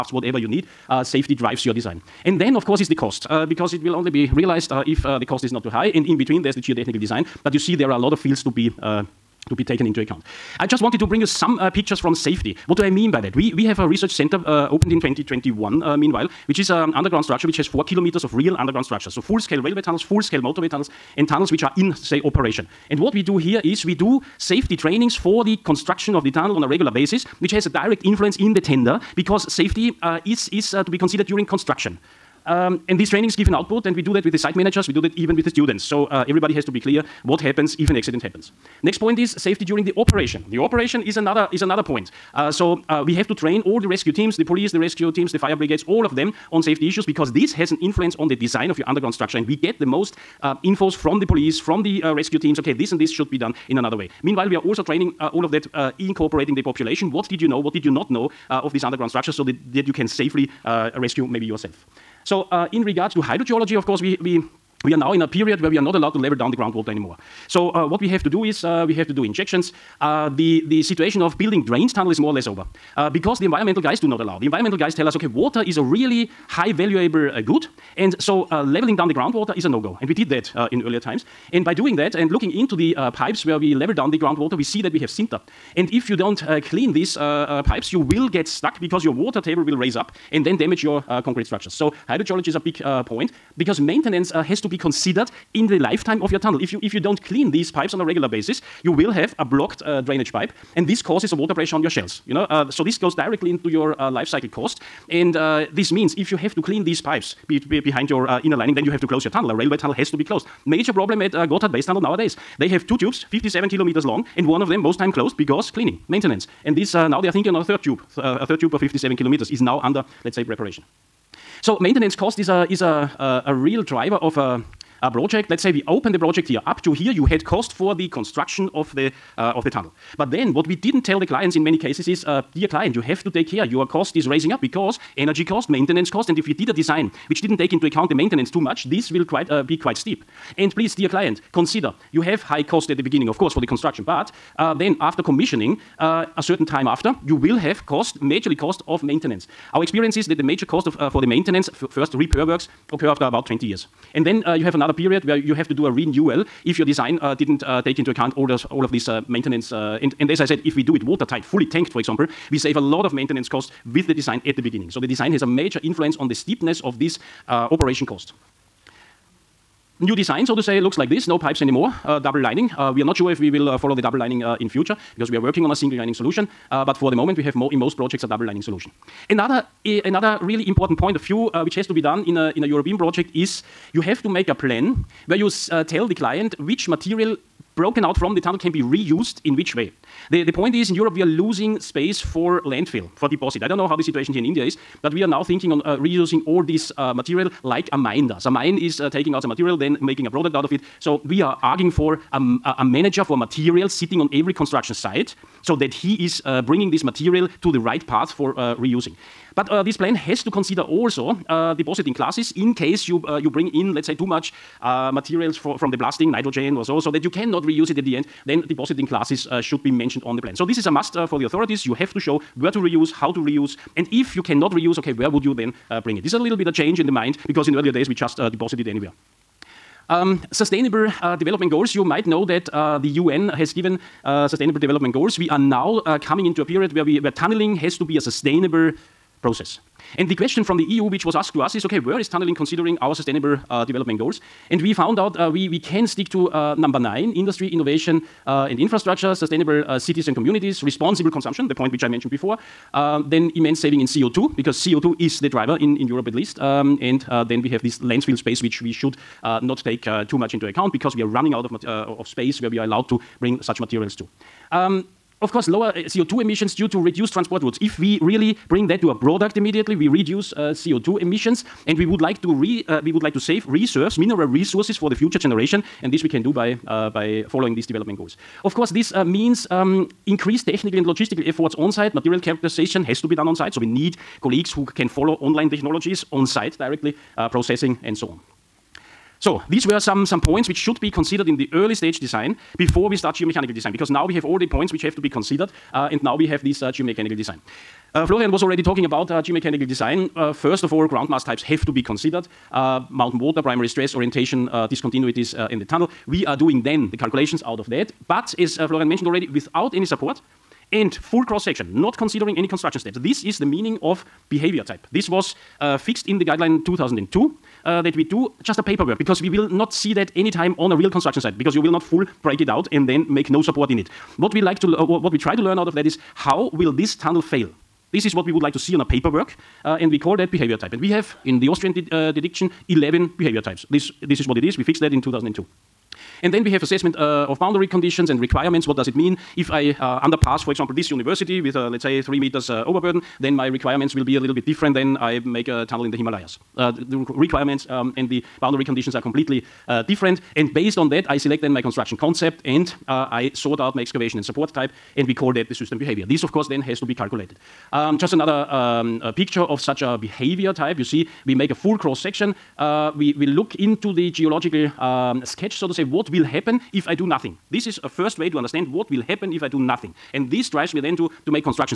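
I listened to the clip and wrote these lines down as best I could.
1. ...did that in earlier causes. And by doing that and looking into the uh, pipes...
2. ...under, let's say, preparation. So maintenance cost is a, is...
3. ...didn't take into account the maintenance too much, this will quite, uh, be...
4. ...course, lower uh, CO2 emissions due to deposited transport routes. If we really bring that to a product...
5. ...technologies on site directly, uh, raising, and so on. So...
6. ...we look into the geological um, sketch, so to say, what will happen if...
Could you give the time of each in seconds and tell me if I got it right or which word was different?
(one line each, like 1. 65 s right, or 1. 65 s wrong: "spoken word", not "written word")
1. 80 s wrong: "times", not "causes"
2. 119 s right
3. 137 s right
4. 265 s wrong: "reduced", not "deposited"
5. 285 s wrong: "processing", not "raising"
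6. 363 s right.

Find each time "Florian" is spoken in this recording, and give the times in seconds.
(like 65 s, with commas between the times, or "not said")
298 s, 308 s.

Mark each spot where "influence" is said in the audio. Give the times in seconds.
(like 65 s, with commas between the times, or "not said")
28 s, 47 s, 165 s.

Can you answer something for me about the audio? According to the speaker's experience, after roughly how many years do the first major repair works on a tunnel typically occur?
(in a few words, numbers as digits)
20 years.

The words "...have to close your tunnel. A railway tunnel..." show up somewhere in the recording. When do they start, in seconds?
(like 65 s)
108 s.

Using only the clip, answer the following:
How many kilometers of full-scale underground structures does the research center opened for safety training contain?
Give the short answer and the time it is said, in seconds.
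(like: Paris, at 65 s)
4, at 17 s.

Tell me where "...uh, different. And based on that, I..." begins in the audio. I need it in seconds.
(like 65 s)
349 s.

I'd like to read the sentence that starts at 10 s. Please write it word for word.
I just wanted to bring you some uh, pictures from safety.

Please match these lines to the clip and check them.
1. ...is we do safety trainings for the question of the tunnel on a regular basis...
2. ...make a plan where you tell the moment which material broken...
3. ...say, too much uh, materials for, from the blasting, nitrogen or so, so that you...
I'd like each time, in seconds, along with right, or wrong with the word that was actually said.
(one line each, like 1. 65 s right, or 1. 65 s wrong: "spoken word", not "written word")
1. 23 s wrong: "construction", not "question"
2. 184 s wrong: "client", not "moment"
3. 214 s right.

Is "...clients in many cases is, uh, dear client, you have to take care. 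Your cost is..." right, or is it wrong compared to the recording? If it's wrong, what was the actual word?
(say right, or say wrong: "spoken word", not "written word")
right.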